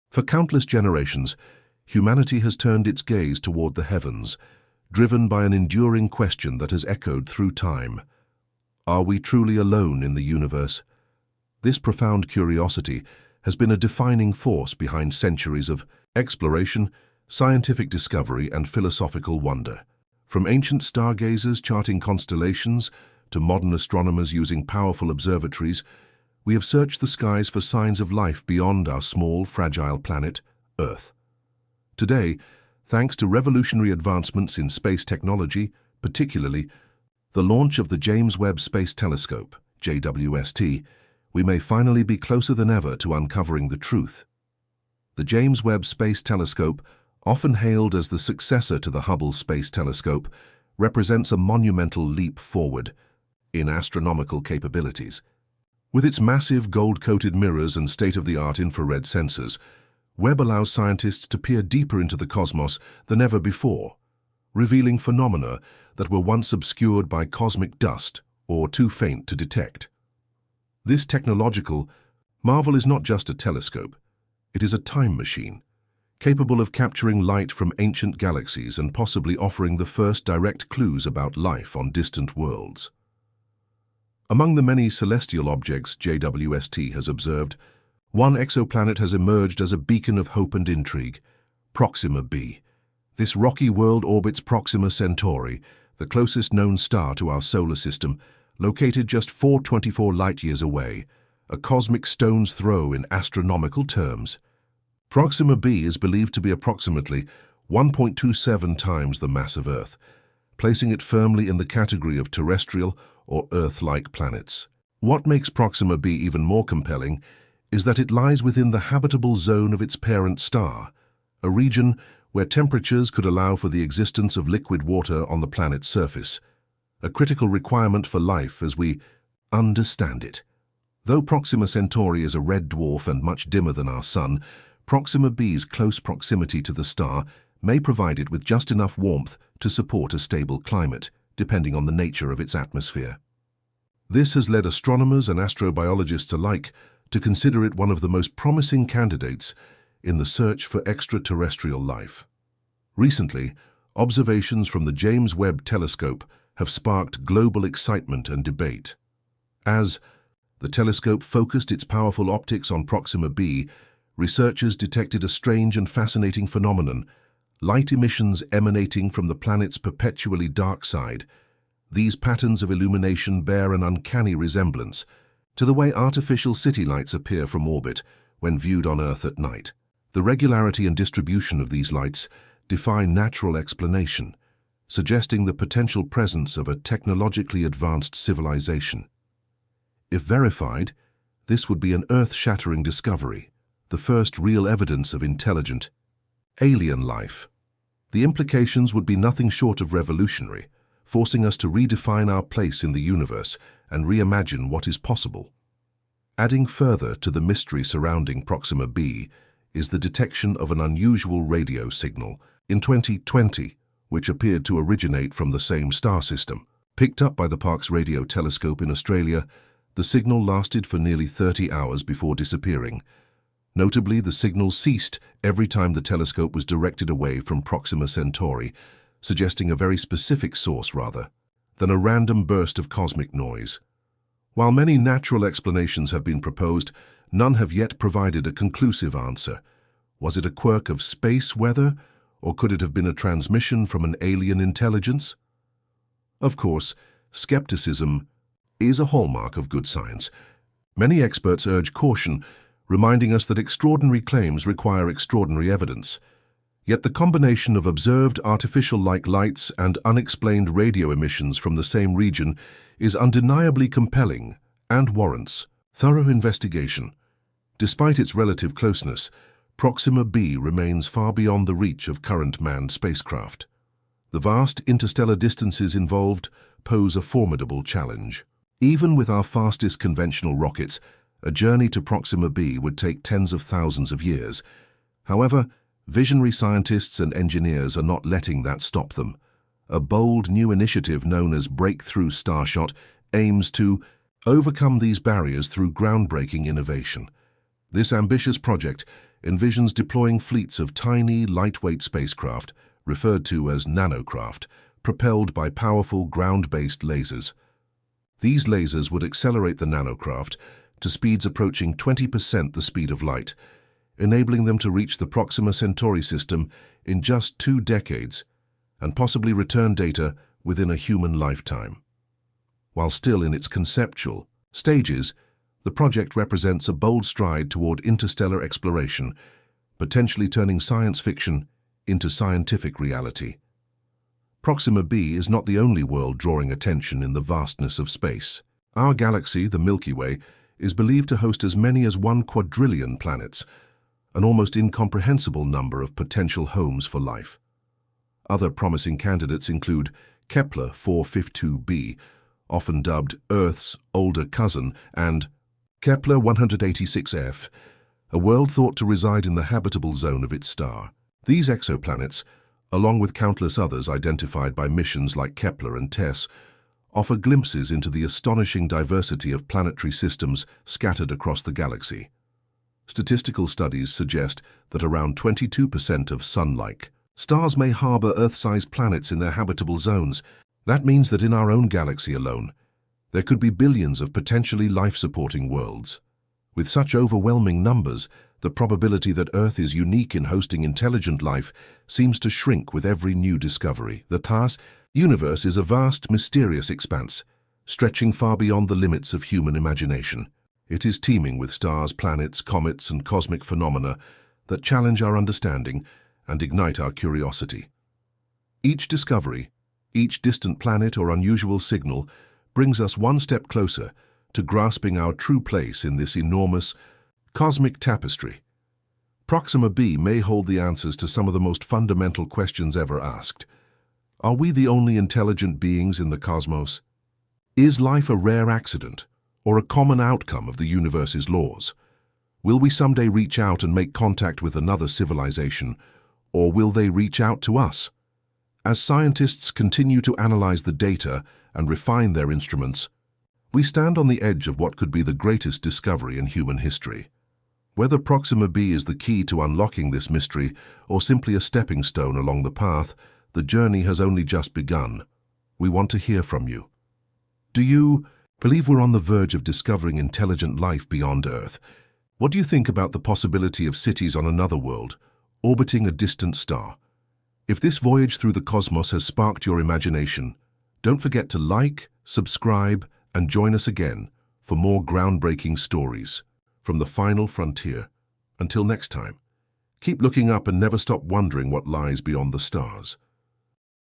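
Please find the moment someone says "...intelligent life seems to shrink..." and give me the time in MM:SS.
06:30.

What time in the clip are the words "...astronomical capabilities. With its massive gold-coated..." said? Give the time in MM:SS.
00:53.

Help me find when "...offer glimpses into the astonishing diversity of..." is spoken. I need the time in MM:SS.
06:07.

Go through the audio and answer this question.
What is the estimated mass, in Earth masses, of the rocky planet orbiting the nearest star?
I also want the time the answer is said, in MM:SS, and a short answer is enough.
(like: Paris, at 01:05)
1.27, at 01:47.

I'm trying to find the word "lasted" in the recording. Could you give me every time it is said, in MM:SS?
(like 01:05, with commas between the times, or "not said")
03:40.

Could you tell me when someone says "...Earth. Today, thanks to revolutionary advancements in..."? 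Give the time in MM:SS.
00:30.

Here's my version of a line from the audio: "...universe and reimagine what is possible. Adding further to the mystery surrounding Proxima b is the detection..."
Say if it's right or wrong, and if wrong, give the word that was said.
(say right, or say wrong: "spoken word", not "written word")
right.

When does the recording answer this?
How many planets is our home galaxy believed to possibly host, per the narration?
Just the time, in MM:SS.
05:42.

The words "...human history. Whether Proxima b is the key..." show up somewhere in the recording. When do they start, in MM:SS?
07:26.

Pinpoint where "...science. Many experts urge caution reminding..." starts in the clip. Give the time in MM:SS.
04:09.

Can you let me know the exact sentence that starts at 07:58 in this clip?
Until next time, keep looking up and never stop wondering what lies beyond the stars.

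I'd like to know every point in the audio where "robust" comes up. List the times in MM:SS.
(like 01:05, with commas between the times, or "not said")
not said.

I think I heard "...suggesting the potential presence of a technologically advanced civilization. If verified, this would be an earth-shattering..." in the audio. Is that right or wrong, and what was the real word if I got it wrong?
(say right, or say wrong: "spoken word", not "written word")
right.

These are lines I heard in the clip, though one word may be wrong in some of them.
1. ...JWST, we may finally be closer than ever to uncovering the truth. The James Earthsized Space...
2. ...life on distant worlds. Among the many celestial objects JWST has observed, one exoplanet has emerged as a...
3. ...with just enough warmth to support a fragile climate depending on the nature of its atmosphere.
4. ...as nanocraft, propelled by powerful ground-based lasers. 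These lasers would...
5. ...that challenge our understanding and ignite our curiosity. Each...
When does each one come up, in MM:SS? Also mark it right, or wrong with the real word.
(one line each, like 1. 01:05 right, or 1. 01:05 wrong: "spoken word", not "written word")
1. 00:39 wrong: "Webb", not "Earthsized"
2. 01:21 right
3. 02:18 wrong: "stable", not "fragile"
4. 05:03 right
5. 06:44 right.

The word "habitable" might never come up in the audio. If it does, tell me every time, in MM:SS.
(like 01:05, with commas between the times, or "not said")
01:58, 05:59, 06:19.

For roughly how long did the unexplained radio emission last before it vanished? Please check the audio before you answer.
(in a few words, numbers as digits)
nearly 30 hours.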